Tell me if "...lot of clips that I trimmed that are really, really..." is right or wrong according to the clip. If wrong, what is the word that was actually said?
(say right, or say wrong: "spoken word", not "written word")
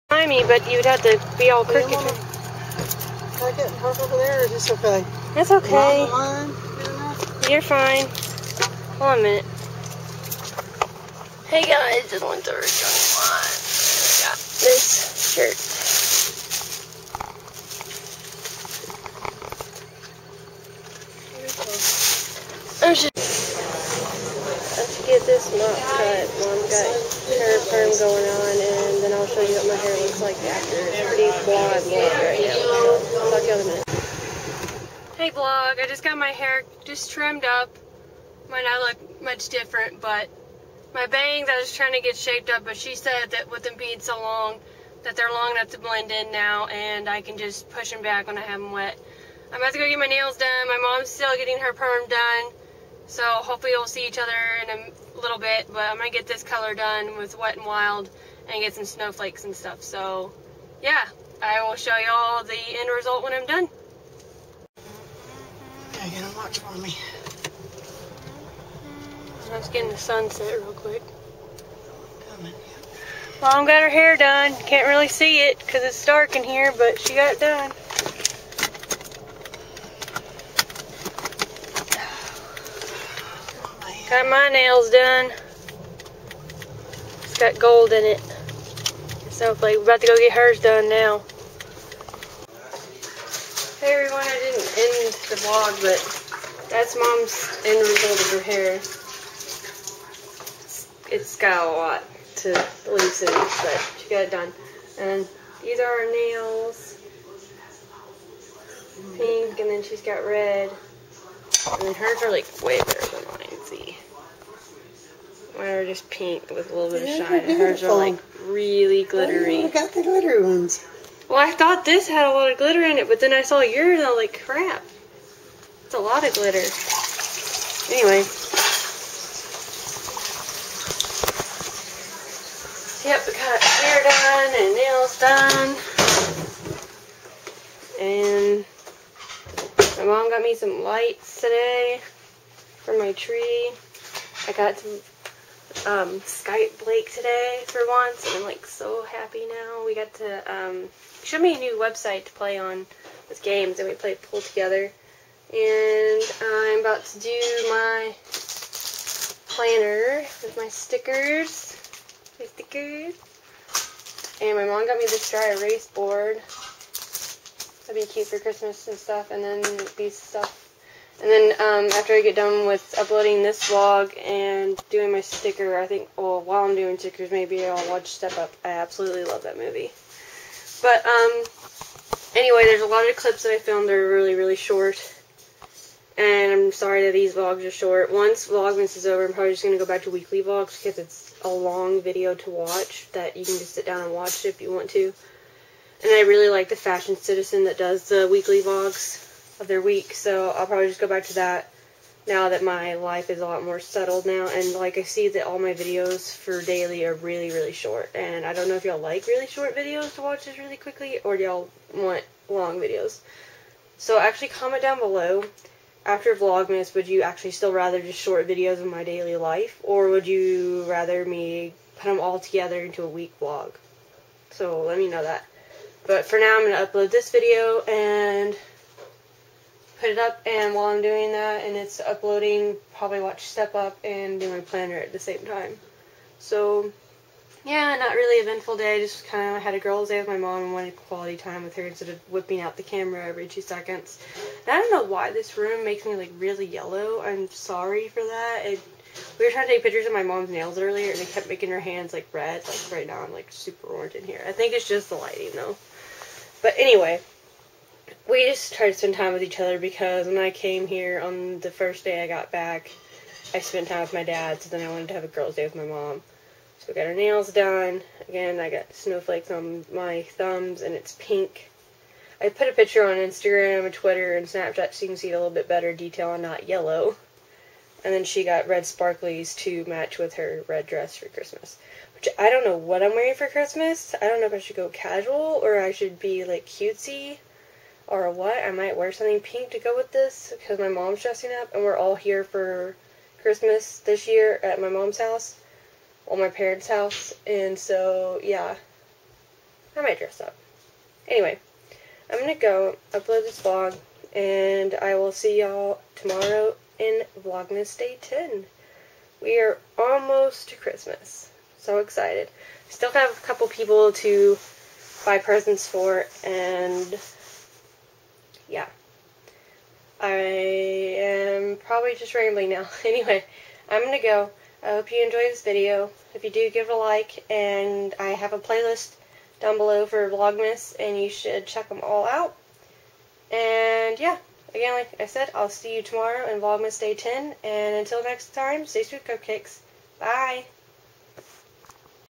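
wrong: "filmed", not "trimmed".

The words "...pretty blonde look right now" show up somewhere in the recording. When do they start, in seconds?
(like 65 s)
31 s.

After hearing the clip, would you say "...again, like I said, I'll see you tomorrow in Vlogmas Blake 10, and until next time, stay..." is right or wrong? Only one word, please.
wrong.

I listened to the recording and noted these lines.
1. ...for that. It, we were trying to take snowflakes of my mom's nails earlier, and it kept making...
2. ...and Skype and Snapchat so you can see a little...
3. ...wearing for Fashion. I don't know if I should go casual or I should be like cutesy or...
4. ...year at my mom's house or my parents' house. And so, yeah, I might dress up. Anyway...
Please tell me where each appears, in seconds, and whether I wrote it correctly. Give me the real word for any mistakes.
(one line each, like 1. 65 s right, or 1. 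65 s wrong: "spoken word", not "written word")
1. 248 s wrong: "pictures", not "snowflakes"
2. 273 s wrong: "Twitter", not "Skype"
3. 283 s wrong: "Christmas", not "Fashion"
4. 294 s right.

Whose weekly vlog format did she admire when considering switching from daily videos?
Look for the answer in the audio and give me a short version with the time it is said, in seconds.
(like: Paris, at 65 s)
Fashion Citizen, at 196 s.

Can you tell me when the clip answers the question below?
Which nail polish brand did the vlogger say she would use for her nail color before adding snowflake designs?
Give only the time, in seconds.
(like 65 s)
57 s.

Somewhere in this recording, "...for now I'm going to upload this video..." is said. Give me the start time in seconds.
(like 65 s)
226 s.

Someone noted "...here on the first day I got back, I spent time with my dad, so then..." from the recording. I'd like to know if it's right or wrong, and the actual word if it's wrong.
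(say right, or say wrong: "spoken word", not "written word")
right.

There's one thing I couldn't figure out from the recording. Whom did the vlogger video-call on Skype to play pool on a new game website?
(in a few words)
Blake.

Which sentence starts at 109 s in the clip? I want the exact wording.
Pink, and then she's got red.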